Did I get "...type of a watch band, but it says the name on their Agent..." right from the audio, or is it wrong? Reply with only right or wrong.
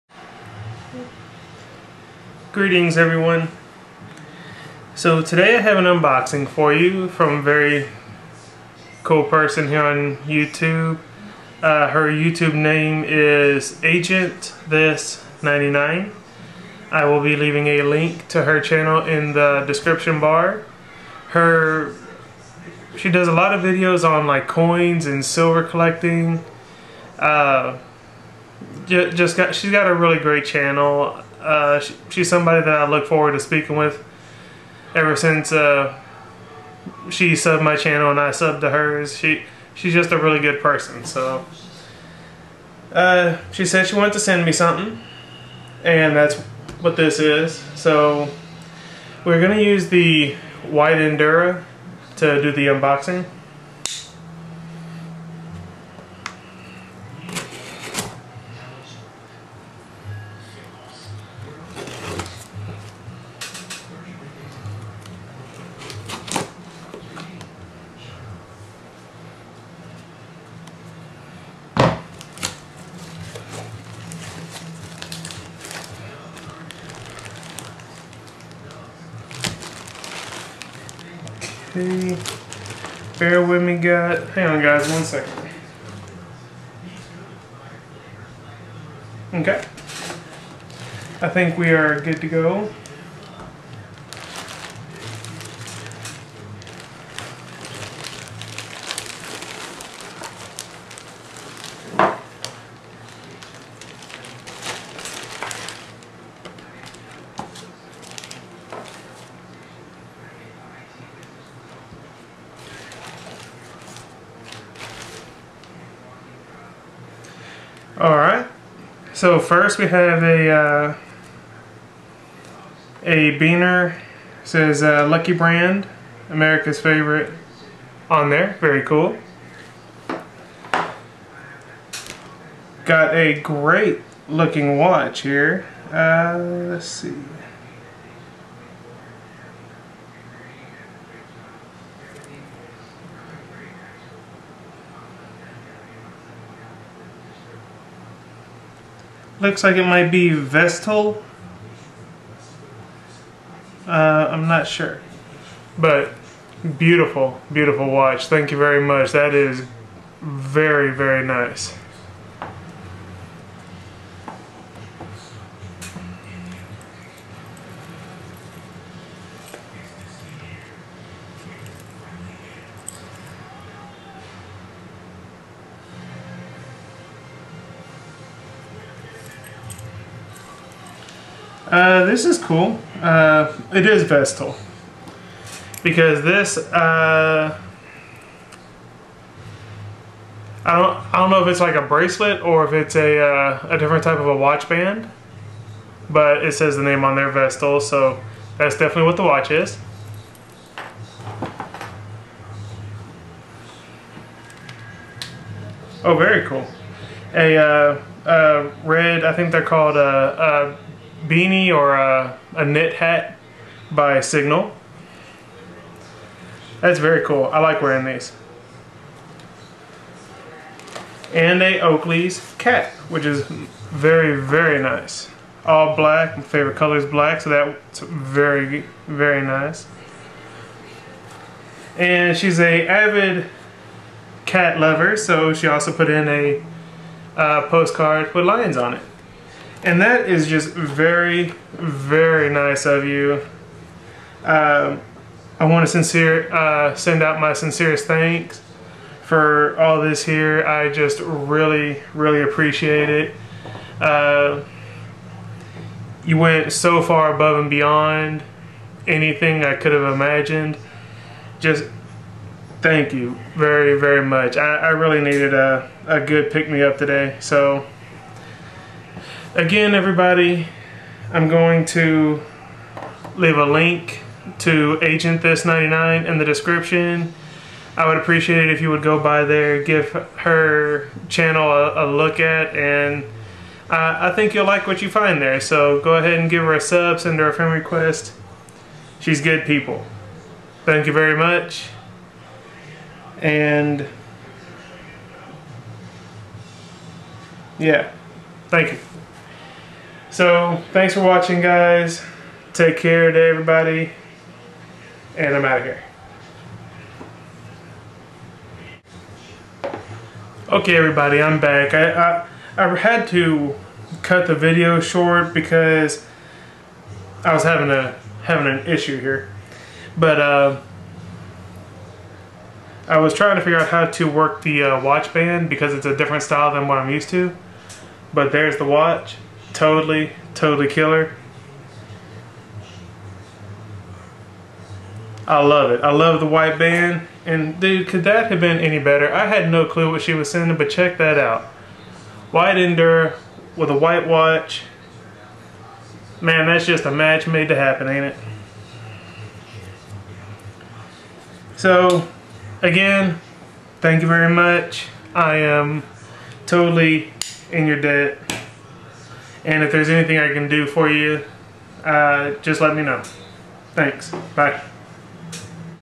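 wrong.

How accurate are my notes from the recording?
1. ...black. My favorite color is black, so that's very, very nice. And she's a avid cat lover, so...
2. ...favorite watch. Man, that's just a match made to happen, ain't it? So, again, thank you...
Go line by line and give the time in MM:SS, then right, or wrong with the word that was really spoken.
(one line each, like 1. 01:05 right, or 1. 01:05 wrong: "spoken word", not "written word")
1. 03:45 right
2. 05:43 wrong: "white", not "favorite".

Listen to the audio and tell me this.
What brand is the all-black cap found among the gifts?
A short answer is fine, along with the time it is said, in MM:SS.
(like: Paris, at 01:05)
Oakley, at 03:41.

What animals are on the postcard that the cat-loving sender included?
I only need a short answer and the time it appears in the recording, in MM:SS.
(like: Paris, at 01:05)
Lions, at 03:58.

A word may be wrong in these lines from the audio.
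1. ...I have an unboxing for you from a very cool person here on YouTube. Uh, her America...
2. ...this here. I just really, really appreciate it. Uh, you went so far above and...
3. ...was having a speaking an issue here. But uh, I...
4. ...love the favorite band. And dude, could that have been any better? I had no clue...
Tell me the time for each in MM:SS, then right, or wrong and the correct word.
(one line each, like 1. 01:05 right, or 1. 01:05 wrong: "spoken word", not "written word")
1. 00:05 wrong: "YouTube", not "America"
2. 04:10 right
3. 05:17 wrong: "having", not "speaking"
4. 05:36 wrong: "white", not "favorite".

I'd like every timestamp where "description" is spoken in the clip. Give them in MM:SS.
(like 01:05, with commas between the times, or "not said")
00:19, 04:36.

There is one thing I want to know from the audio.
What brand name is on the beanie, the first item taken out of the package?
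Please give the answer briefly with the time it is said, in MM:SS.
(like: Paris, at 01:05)
Lucky Brand, at 02:05.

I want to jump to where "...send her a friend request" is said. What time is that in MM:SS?
04:47.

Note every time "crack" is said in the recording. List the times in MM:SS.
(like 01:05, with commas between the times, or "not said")
not said.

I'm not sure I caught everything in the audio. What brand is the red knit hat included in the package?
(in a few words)
Signal.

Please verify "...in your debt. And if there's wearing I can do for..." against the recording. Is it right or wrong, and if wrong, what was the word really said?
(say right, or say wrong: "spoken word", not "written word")
wrong: "anything", not "wearing".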